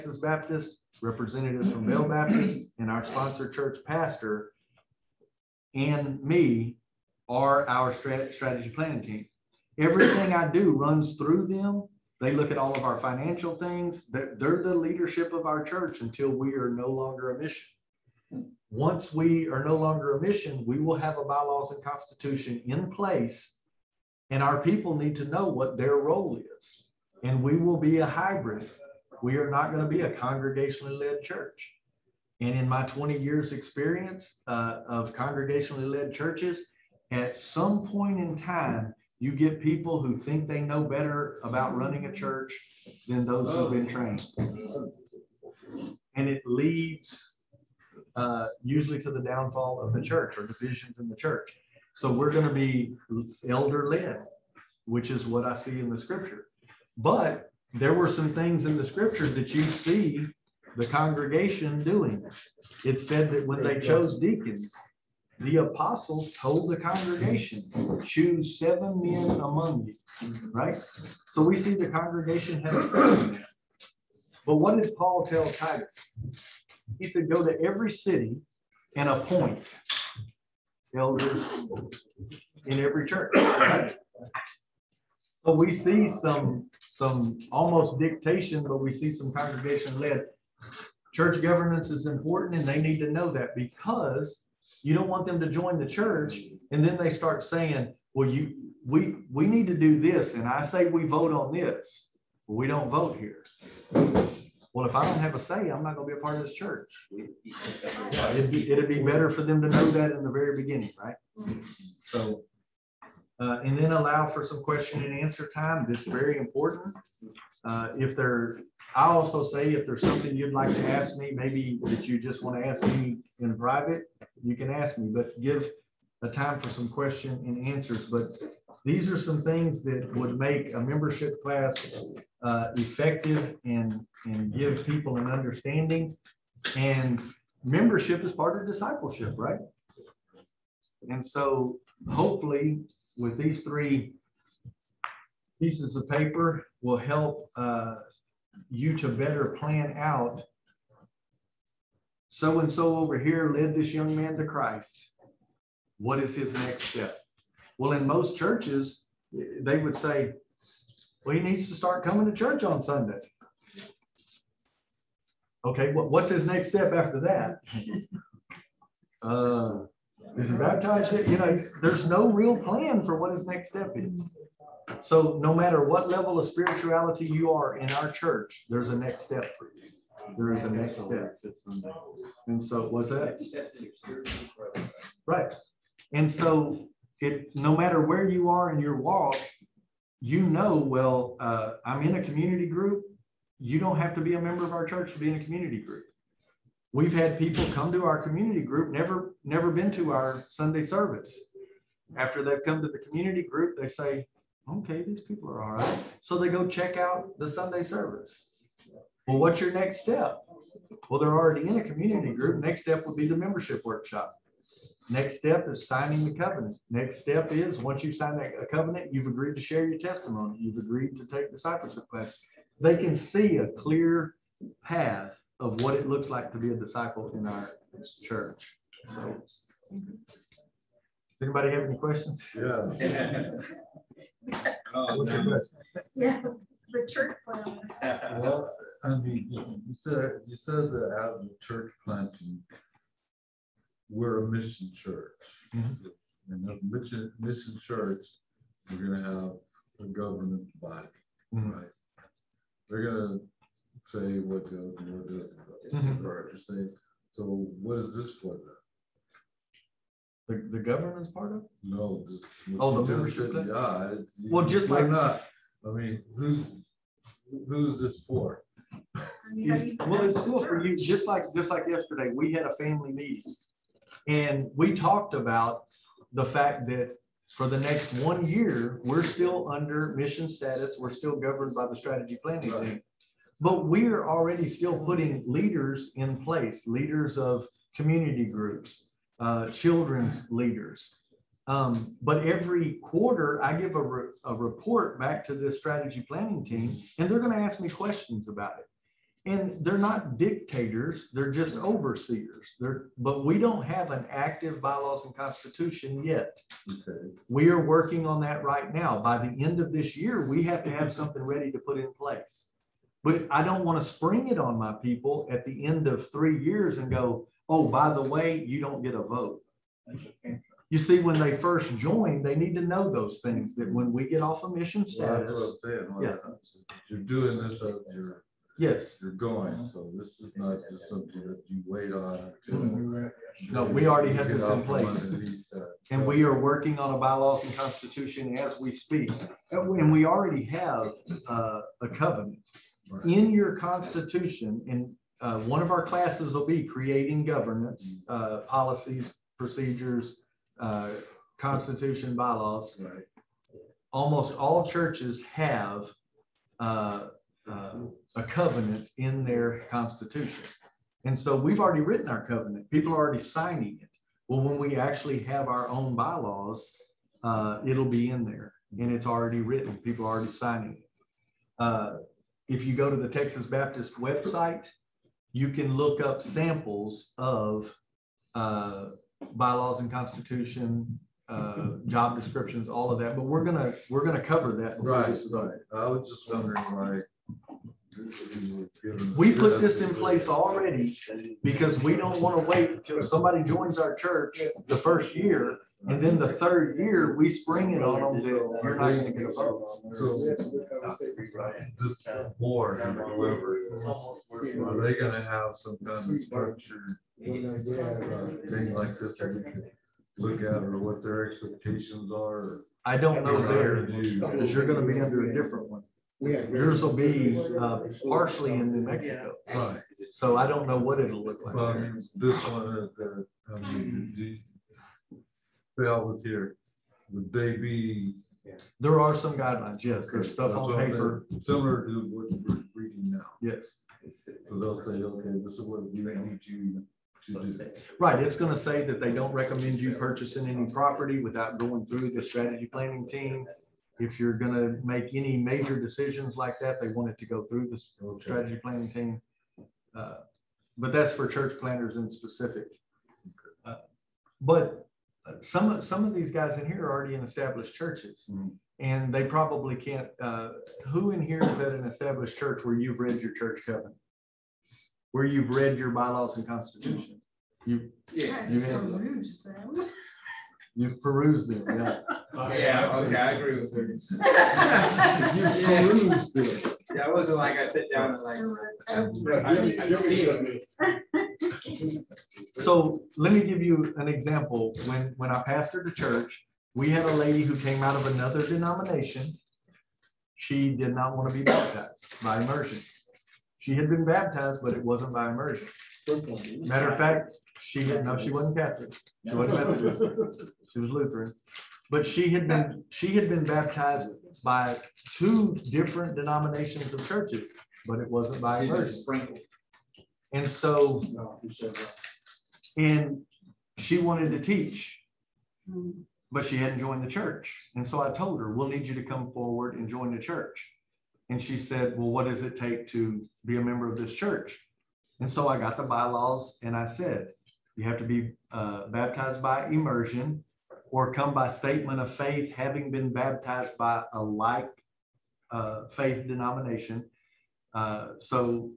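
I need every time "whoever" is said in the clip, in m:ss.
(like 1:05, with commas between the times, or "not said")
6:43.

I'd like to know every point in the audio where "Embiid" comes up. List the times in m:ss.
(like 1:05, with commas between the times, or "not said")
not said.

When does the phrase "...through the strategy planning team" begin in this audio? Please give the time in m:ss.
7:22.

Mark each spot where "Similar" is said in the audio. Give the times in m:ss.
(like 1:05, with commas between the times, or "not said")
7:11.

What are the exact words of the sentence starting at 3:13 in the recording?
You don't have to be a member of our church to be in a community group.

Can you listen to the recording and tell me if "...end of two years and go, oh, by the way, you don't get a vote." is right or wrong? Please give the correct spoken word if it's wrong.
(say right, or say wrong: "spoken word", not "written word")
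wrong: "three", not "two".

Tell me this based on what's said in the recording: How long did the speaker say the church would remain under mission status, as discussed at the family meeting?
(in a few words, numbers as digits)
1 year.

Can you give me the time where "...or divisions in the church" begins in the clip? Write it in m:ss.
0:50.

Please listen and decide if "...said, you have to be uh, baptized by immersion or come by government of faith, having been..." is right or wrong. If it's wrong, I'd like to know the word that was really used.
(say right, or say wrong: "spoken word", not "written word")
wrong: "statement", not "government".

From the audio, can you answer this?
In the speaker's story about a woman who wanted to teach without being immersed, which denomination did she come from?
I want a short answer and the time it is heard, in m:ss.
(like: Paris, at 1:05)
Lutheran, at 8:21.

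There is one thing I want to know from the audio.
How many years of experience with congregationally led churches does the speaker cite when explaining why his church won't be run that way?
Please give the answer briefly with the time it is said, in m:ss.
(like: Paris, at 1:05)
20, at 0:32.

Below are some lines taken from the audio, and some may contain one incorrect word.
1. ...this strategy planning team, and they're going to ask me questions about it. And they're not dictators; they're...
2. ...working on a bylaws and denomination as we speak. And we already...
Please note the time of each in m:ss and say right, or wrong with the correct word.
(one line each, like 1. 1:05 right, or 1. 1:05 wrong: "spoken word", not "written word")
1. 4:55 right
2. 5:36 wrong: "constitution", not "denomination".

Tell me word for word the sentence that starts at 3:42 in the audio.
They can see a clear path of what it looks like to be a disciple in our church.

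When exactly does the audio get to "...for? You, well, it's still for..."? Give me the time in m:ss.
4:28.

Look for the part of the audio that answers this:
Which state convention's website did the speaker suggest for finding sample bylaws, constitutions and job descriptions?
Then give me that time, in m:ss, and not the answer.
6:13.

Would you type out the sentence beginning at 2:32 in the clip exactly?
So and so over here led this young man to Christ.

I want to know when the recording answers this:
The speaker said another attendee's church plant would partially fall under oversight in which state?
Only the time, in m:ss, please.
6:58.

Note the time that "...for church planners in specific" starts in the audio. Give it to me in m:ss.
7:31.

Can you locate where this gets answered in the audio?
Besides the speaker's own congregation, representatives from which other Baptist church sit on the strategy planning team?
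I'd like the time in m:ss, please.
0:01.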